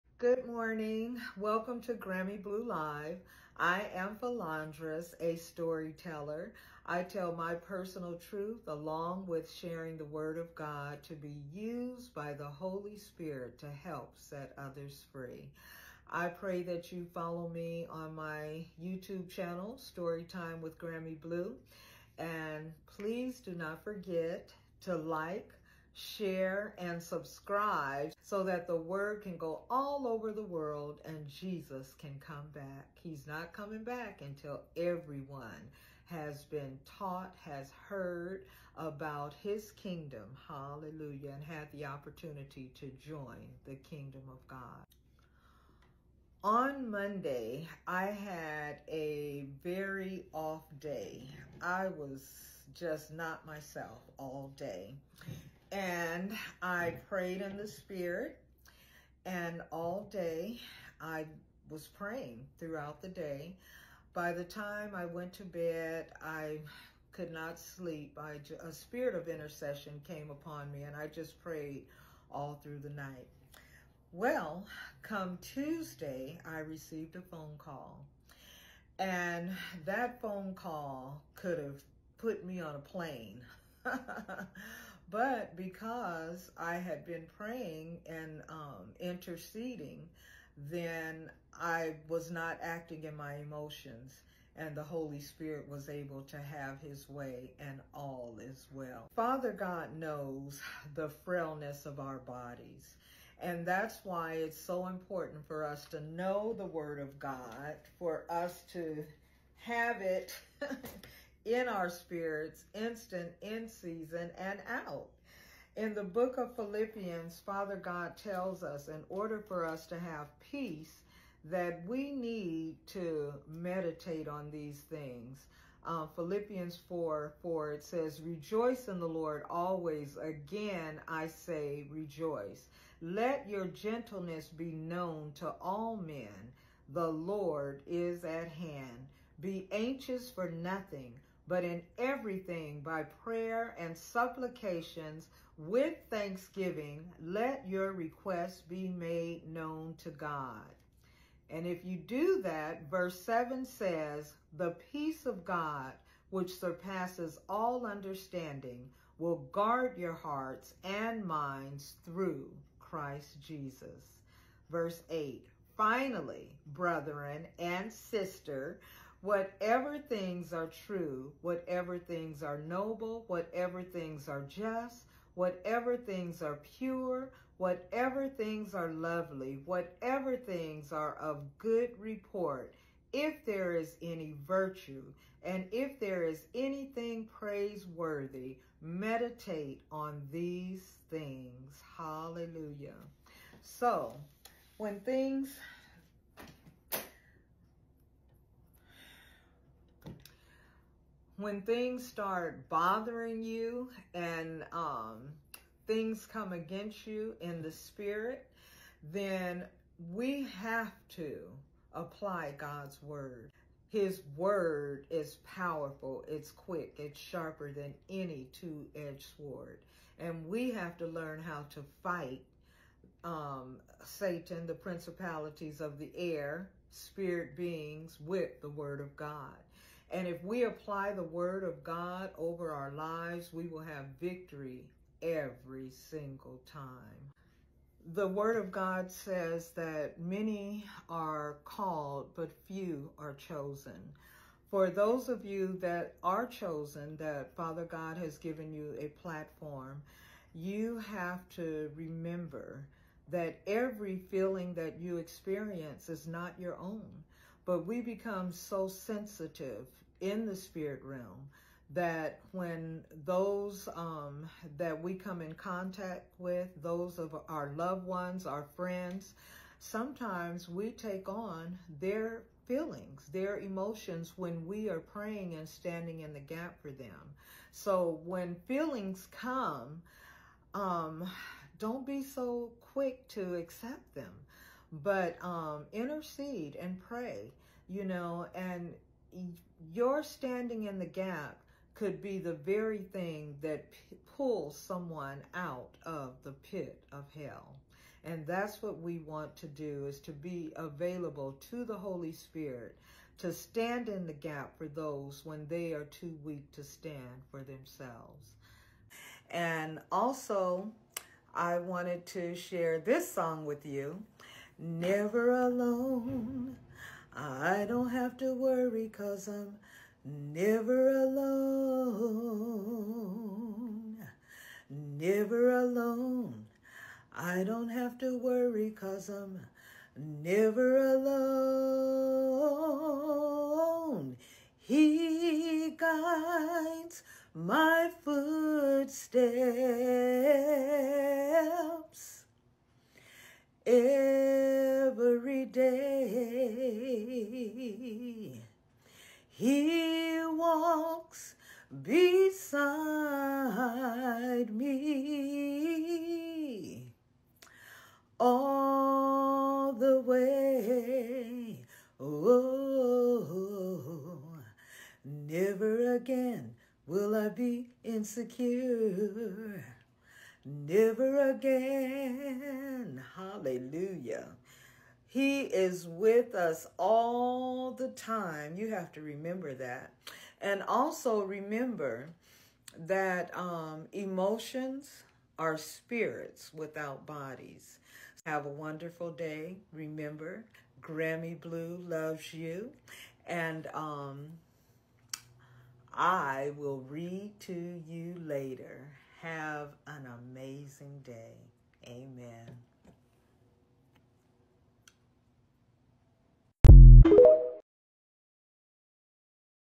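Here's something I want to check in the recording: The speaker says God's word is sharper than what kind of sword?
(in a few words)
Two-edged sword.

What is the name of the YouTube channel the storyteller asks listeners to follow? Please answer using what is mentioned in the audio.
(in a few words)
Storytime with Grammy Blue.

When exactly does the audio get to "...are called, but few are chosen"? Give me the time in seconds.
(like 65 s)
241 s.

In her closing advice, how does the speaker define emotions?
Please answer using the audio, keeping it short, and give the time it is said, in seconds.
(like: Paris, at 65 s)
Spirits without bodies, at 385 s.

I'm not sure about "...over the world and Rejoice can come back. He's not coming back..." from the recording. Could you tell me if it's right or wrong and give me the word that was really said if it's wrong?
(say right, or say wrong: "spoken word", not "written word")
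wrong: "Jesus", not "Rejoice".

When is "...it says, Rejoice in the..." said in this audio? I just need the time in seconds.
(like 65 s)
127 s.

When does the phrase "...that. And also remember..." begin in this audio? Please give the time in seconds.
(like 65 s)
379 s.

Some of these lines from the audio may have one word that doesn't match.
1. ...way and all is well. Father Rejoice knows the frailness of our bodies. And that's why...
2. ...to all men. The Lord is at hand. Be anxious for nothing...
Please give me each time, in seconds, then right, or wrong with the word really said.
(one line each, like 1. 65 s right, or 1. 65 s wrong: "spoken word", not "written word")
1. 97 s wrong: "God", not "Rejoice"
2. 135 s right.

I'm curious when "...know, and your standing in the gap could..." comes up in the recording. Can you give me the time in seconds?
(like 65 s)
288 s.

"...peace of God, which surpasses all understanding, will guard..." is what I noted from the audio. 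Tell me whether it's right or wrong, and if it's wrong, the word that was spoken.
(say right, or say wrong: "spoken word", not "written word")
right.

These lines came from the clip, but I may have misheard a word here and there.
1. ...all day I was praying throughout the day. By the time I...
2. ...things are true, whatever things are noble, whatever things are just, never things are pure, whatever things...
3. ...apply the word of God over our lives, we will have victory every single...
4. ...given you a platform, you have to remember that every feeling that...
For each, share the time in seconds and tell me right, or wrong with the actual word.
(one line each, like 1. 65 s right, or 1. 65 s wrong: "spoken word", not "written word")
1. 59 s right
2. 169 s wrong: "whatever", not "never"
3. 230 s right
4. 248 s right.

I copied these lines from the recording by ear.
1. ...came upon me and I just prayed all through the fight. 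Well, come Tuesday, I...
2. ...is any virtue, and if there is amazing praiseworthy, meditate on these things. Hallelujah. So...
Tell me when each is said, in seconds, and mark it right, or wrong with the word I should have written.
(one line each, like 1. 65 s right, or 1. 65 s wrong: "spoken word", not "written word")
1. 70 s wrong: "night", not "fight"
2. 183 s wrong: "anything", not "amazing".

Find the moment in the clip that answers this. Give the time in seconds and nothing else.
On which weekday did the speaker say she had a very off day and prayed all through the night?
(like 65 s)
46 s.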